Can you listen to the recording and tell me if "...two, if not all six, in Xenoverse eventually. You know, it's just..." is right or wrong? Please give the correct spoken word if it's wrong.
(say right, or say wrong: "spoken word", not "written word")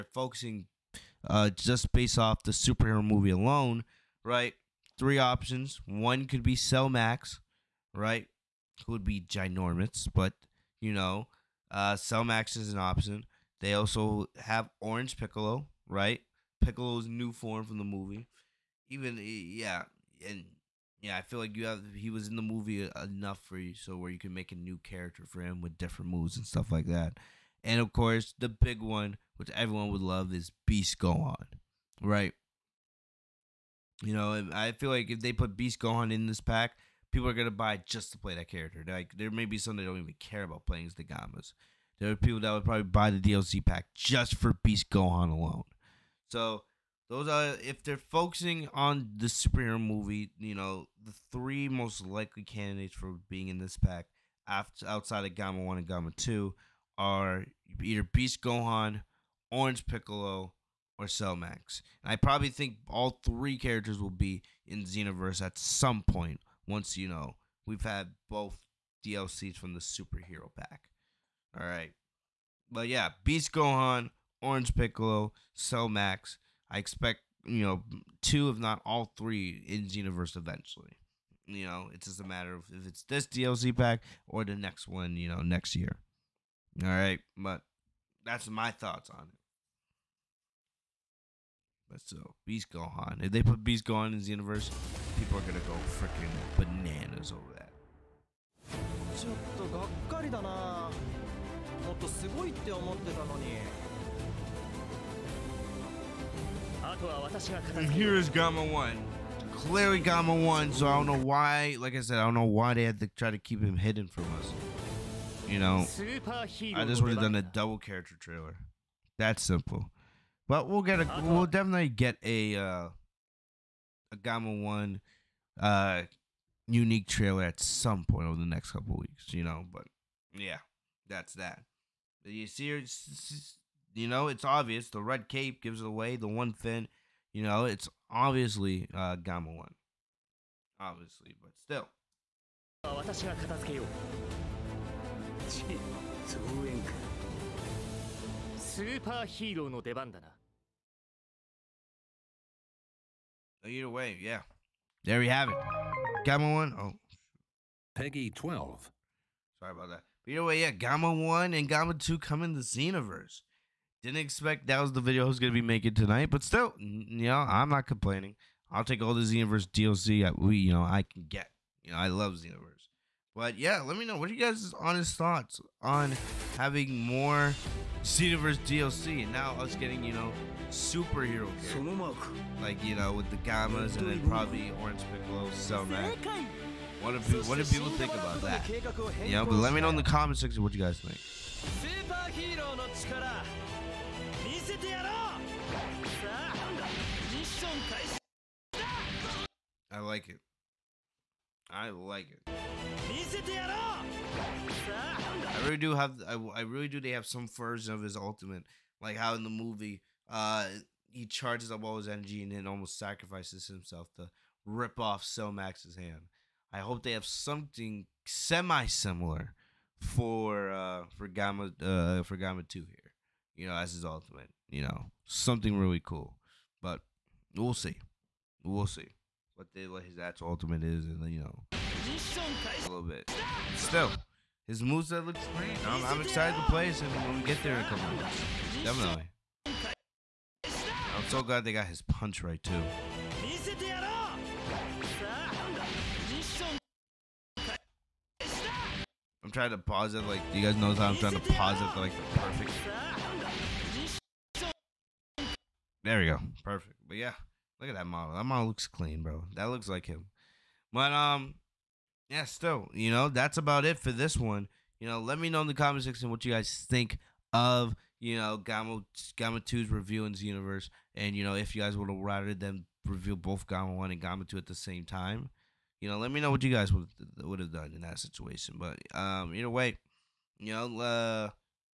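wrong: "three", not "six".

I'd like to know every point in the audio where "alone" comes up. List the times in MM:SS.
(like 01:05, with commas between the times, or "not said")
00:03, 00:45.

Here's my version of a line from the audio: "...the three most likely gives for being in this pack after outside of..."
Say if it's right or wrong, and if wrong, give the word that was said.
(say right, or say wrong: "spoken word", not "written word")
wrong: "candidates", not "gives".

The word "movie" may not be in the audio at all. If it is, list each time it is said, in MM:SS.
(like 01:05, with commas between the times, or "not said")
00:03, 00:17, 00:22, 00:49, 03:29.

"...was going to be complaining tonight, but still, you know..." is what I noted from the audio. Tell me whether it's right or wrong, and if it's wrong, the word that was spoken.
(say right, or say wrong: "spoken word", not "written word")
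wrong: "making", not "complaining".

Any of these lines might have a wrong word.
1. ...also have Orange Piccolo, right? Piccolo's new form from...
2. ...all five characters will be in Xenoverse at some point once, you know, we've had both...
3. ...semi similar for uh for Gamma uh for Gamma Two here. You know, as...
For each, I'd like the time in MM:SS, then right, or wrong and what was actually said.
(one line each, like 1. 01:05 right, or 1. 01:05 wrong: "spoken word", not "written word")
1. 00:13 right
2. 01:02 wrong: "three", not "five"
3. 03:38 right.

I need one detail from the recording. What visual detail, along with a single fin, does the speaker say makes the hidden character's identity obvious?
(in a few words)
red cape.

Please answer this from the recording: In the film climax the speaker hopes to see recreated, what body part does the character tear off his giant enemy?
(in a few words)
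hand.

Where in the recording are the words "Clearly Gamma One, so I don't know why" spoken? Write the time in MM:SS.
01:49.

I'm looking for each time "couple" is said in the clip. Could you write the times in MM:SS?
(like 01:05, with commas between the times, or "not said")
02:08, 03:57.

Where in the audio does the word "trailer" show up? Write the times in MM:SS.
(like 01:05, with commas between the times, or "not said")
01:58, 02:07.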